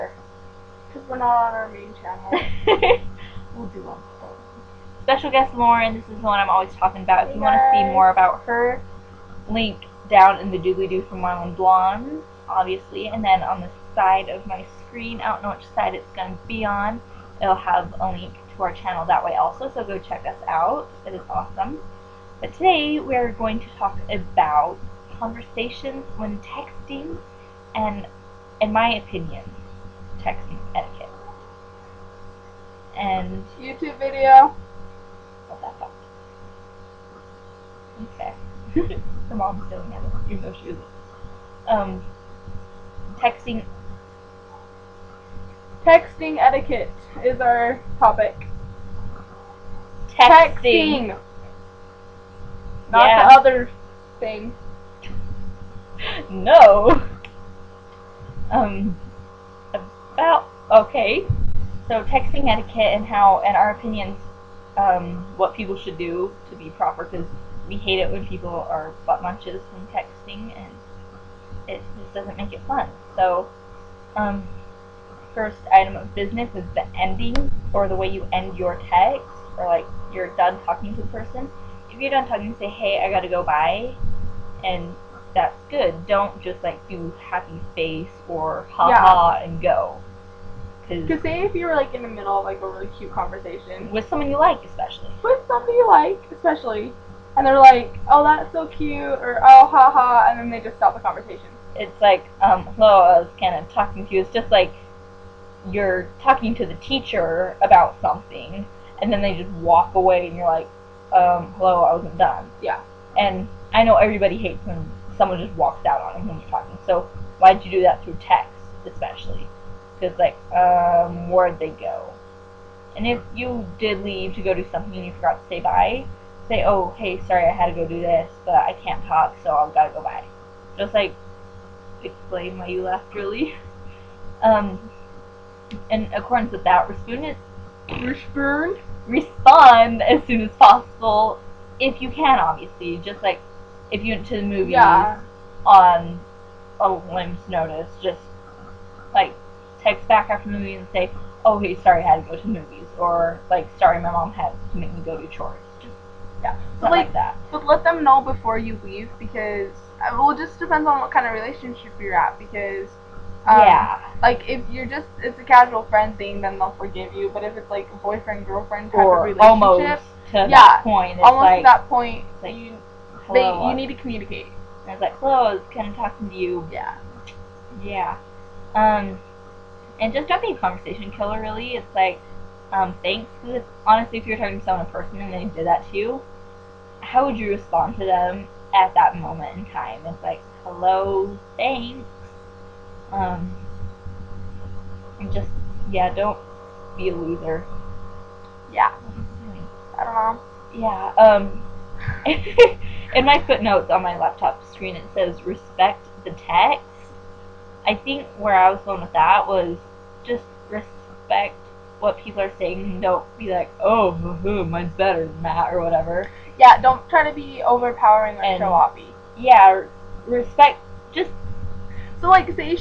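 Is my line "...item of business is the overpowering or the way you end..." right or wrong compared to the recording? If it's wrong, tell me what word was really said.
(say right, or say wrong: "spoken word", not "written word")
wrong: "ending", not "overpowering".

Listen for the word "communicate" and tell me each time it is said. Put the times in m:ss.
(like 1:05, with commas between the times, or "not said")
2:53.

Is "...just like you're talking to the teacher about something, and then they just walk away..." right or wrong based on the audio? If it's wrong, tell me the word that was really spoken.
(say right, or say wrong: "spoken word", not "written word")
right.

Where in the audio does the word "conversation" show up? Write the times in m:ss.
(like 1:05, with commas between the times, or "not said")
0:25, 1:33, 1:40, 3:00.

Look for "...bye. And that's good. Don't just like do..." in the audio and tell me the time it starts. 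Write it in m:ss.
1:23.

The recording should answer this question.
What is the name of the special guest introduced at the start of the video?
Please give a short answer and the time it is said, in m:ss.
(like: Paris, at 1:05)
Lauren, at 0:05.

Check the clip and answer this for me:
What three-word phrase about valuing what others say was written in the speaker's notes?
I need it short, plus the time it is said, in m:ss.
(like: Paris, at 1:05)
respect the text, at 3:25.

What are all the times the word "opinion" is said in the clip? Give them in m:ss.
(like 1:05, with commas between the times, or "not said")
0:28, 1:03.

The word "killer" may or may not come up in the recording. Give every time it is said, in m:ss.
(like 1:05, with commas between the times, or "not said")
3:01.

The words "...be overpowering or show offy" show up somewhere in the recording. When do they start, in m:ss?
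3:37.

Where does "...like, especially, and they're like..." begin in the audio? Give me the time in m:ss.
1:35.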